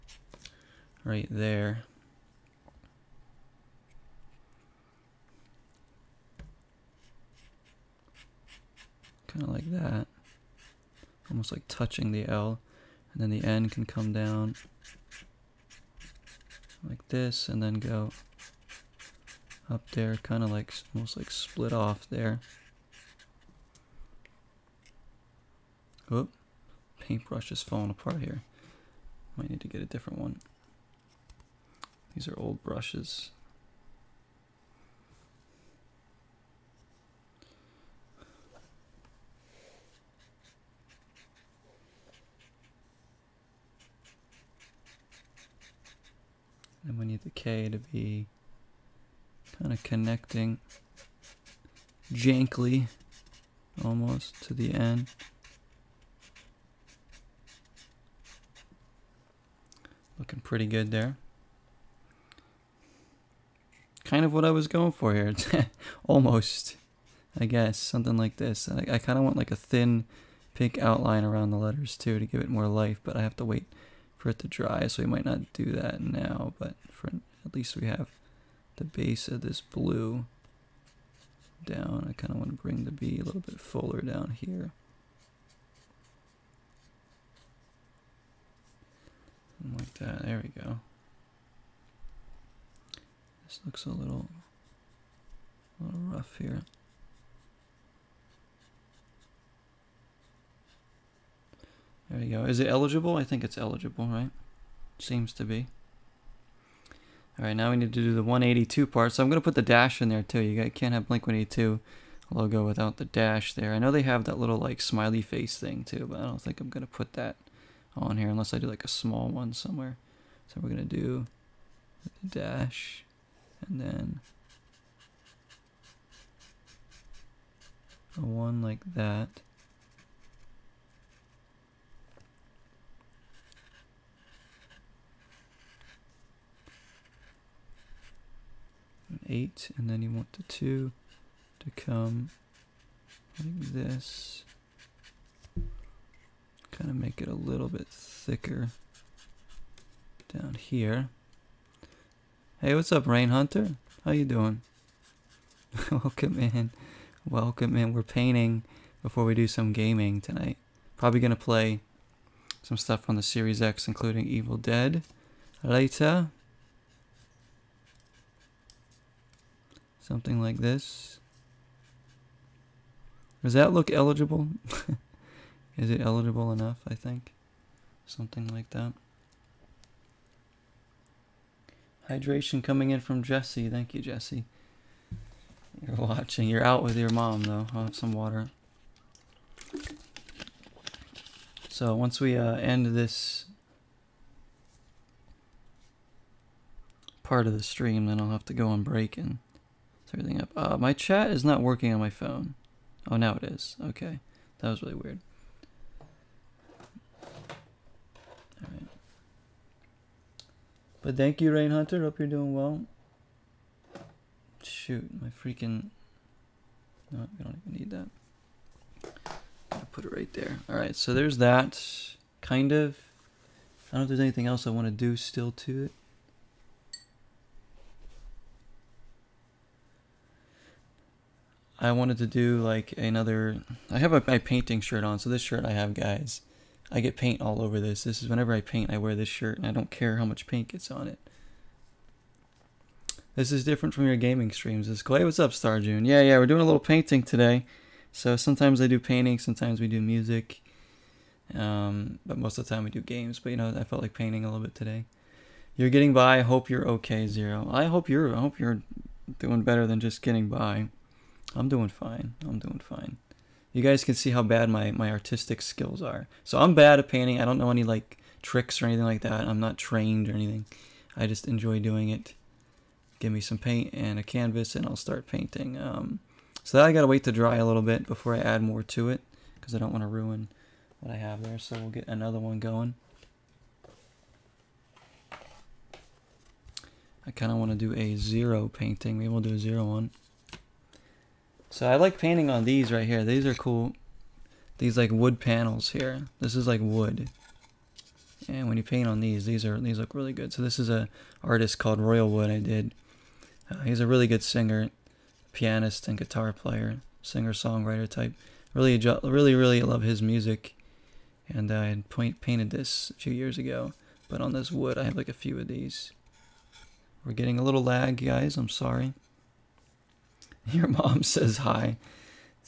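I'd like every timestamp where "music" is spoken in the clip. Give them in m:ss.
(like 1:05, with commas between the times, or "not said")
4:10, 5:10.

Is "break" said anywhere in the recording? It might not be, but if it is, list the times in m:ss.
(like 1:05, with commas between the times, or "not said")
3:18.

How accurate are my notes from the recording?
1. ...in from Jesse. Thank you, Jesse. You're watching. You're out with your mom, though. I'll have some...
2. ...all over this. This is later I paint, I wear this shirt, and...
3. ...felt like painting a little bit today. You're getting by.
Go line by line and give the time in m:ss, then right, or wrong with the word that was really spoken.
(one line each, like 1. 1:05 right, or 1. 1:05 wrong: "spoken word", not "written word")
1. 3:02 right
2. 3:57 wrong: "whenever", not "later"
3. 4:13 right.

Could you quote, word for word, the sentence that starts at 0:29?
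Might need to get a different one.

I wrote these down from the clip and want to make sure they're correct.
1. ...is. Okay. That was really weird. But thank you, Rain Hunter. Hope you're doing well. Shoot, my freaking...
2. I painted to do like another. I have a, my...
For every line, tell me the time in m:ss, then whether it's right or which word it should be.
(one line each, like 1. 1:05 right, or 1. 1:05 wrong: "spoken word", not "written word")
1. 3:23 right
2. 3:51 wrong: "wanted", not "painted".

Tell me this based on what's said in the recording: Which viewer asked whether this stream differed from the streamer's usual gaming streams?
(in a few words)
Star June.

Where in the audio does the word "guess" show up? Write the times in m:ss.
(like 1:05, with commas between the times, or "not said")
1:07.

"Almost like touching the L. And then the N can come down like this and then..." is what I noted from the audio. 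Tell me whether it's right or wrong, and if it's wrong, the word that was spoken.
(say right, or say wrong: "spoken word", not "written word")
right.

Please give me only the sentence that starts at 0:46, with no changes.
and we need the K to be kind of connecting jankly almost to the N.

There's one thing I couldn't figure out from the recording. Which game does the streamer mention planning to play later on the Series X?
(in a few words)
Evil Dead.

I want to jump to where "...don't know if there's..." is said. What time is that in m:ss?
3:43.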